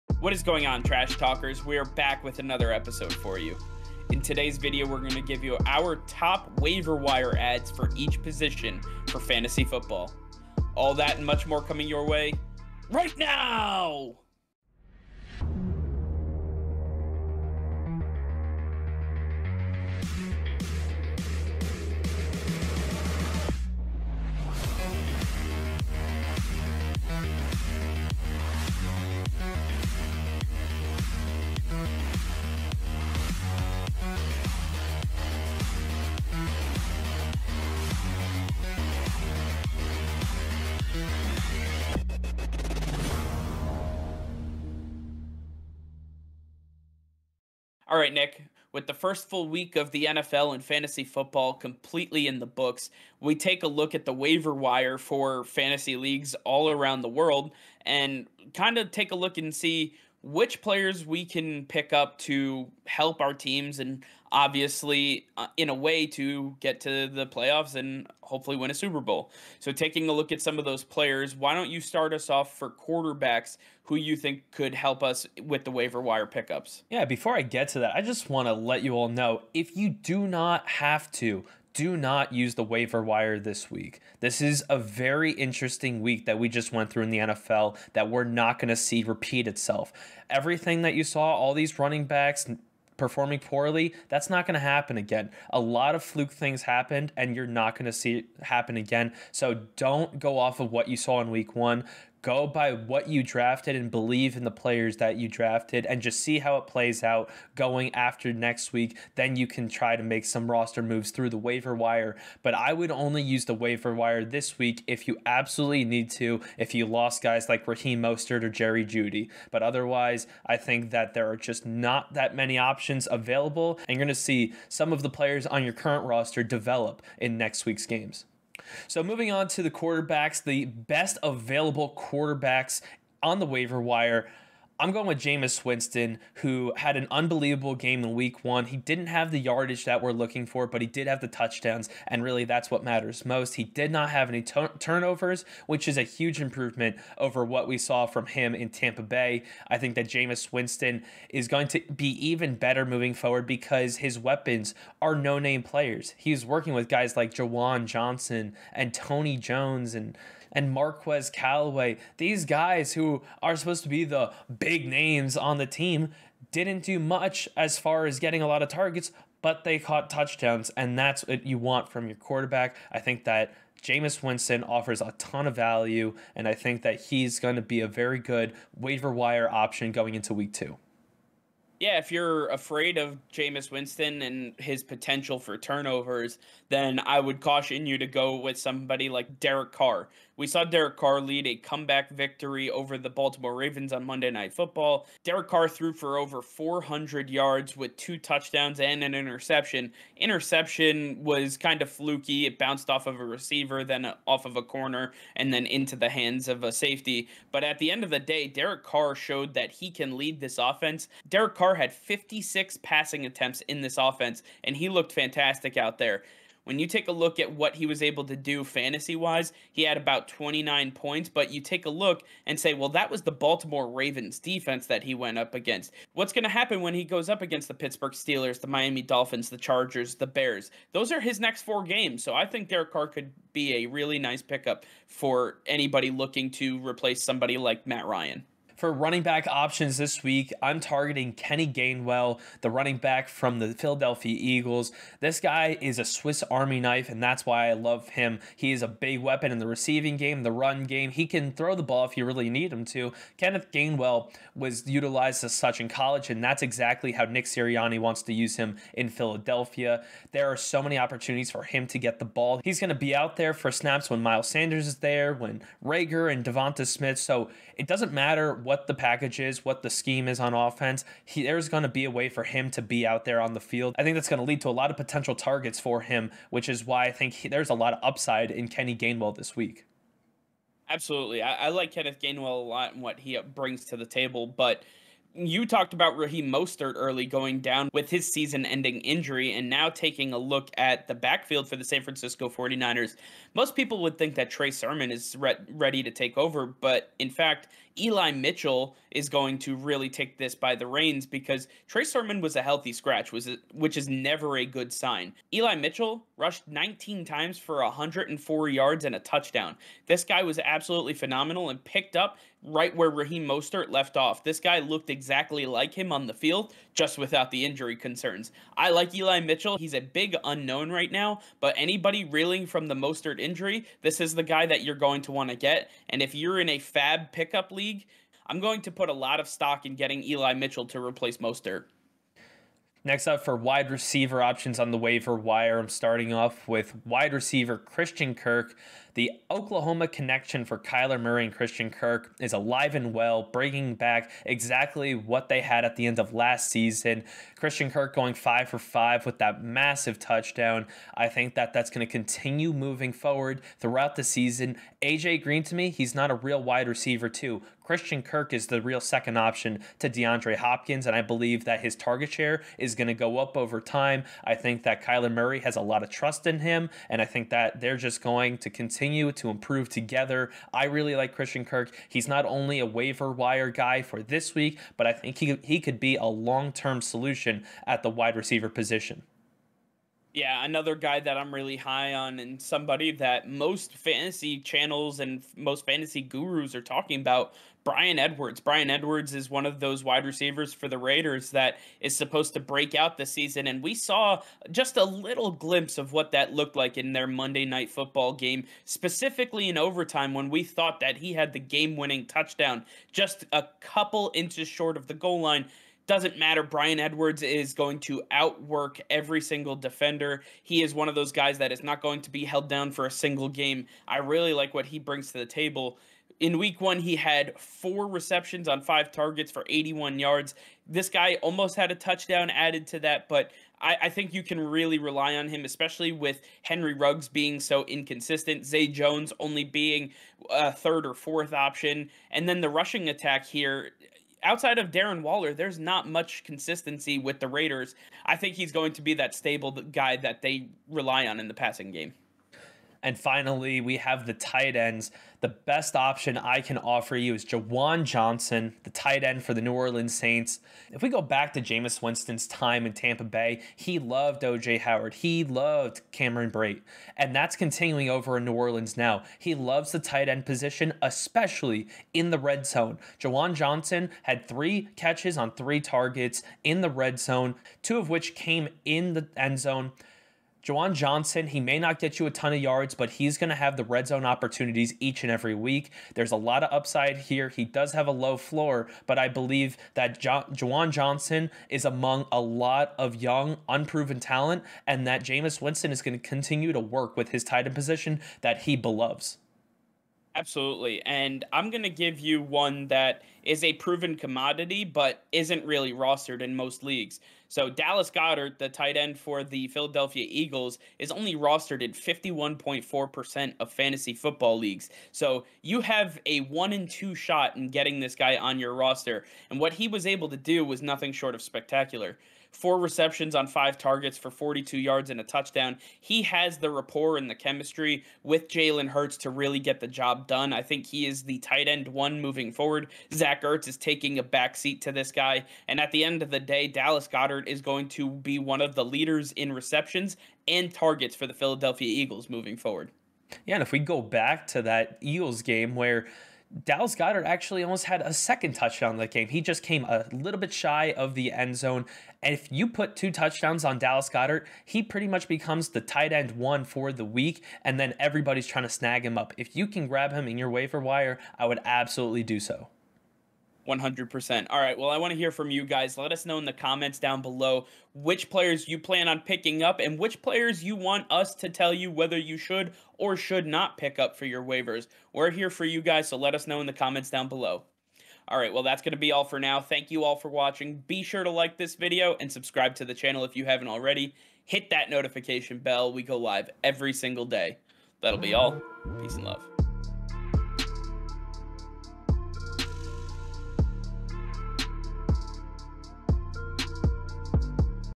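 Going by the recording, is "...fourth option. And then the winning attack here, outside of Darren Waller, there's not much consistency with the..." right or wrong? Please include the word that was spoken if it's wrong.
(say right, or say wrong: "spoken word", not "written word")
wrong: "rushing", not "winning".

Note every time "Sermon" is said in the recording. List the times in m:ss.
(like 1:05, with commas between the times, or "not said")
4:54, 5:02.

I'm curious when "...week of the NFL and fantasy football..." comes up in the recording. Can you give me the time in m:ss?
0:49.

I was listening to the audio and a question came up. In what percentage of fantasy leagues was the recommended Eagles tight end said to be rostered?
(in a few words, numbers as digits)
51.4%.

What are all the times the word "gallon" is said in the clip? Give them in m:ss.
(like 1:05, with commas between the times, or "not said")
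not said.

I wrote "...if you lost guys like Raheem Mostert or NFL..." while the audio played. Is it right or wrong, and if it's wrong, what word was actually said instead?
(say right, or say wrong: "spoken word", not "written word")
wrong: "Jerry", not "NFL".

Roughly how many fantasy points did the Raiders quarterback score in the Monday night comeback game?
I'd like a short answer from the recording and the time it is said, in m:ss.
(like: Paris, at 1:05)
29, at 3:40.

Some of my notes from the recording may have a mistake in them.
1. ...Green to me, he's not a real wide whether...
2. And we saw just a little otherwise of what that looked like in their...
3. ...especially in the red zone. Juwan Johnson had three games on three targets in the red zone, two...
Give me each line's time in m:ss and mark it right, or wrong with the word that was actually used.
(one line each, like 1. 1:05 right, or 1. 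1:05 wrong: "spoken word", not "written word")
1. 5:55 wrong: "receiver", not "whether"
2. 6:33 wrong: "glimpse", not "otherwise"
3. 7:41 wrong: "catches", not "games".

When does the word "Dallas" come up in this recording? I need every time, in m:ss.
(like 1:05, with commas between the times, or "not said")
8:17, 8:46, 8:56, 9:03.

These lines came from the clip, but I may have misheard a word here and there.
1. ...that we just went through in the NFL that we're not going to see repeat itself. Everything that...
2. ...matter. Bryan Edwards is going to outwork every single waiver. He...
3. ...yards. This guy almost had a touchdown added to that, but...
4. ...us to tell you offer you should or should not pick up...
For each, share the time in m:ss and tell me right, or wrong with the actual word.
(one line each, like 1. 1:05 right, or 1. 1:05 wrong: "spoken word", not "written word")
1. 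1:26 right
2. 6:46 wrong: "defender", not "waiver"
3. 7:00 right
4. 9:21 wrong: "whether", not "offer".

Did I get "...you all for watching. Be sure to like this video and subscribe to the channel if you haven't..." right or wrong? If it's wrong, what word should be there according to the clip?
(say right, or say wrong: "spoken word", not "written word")
right.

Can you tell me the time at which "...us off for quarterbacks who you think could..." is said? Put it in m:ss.
1:12.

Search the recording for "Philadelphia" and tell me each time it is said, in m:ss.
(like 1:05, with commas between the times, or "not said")
4:03, 4:19, 8:19, 8:51.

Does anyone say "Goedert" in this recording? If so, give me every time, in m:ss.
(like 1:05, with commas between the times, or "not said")
8:18, 8:47, 8:56, 9:04.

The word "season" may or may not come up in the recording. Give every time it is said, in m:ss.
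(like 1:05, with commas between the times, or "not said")
4:48, 5:46, 5:54, 6:33.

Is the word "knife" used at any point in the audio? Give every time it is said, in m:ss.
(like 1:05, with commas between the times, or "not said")
4:06.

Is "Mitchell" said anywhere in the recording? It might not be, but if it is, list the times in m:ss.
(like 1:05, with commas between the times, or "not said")
4:58, 5:05, 5:19, 5:30.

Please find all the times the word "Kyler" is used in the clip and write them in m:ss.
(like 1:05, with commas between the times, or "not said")
5:40, 6:05.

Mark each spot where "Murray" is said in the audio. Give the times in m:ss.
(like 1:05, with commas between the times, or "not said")
5:41, 6:05.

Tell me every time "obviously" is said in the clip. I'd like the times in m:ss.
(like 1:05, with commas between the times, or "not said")
1:04.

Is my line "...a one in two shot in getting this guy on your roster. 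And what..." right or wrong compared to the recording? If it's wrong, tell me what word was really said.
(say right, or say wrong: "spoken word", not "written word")
right.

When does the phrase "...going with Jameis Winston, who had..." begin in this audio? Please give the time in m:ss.
2:14.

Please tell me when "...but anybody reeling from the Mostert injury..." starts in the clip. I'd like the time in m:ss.
5:21.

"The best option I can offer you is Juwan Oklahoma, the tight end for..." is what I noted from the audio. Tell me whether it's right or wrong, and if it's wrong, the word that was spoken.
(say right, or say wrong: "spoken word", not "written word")
wrong: "Johnson", not "Oklahoma".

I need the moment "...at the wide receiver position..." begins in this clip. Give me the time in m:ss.
6:17.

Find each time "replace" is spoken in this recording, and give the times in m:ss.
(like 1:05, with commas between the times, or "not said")
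3:56, 5:30.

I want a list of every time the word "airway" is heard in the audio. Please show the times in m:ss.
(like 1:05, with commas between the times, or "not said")
not said.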